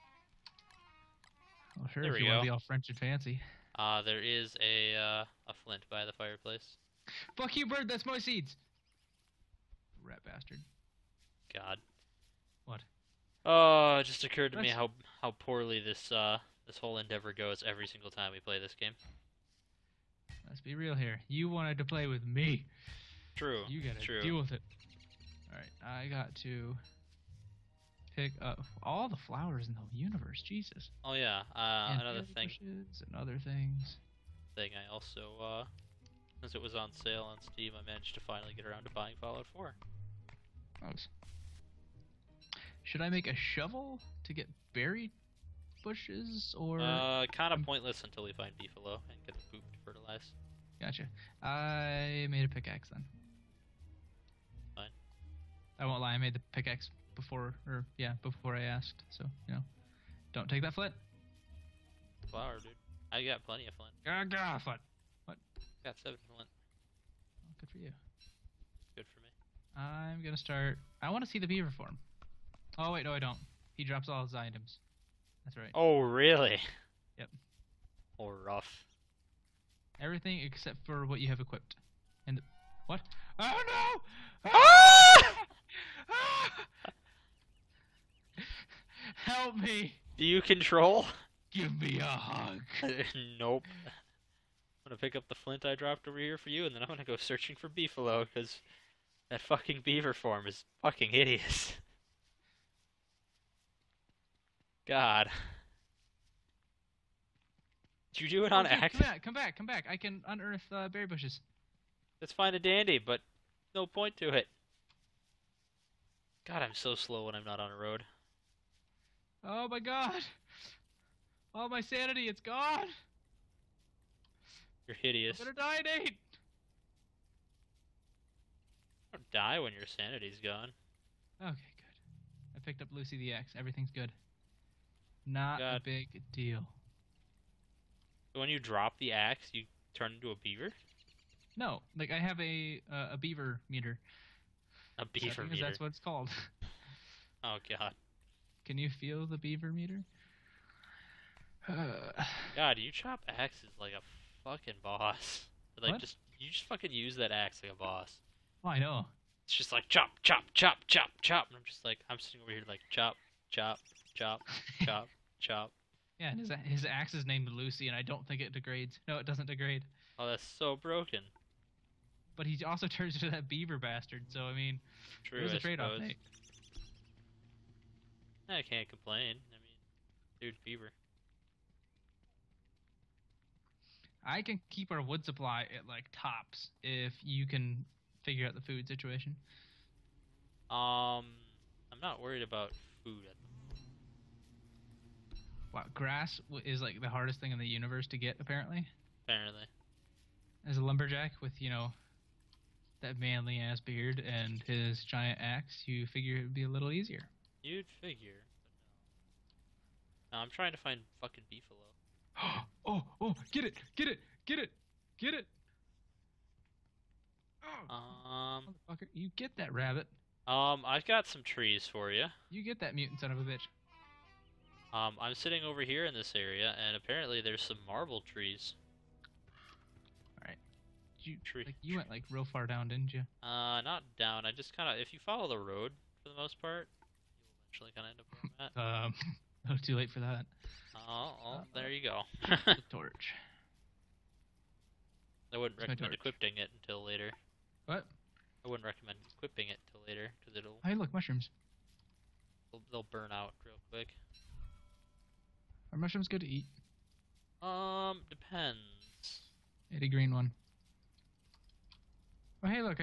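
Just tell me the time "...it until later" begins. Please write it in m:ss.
4:06.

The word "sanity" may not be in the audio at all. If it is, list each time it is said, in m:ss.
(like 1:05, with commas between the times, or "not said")
2:01, 2:09.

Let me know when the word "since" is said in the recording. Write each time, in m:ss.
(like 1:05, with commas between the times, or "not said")
0:36.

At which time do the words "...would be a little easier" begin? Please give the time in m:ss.
3:26.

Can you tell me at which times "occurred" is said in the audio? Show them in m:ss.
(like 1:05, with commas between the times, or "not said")
0:14.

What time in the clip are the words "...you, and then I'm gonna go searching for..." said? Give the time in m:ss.
1:36.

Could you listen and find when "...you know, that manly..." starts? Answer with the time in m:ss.
3:21.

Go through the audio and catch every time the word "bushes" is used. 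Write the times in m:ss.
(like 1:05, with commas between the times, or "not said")
0:45, 1:51.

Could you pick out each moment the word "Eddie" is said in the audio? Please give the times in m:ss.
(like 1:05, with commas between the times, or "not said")
4:19.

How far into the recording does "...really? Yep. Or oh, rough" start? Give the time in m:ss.
1:15.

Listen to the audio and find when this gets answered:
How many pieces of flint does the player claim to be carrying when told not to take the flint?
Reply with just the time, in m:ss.
1:06.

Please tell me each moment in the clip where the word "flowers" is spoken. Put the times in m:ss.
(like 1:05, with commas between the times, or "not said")
0:29, 1:02.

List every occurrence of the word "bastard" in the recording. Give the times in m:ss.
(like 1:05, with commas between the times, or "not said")
0:10, 2:53.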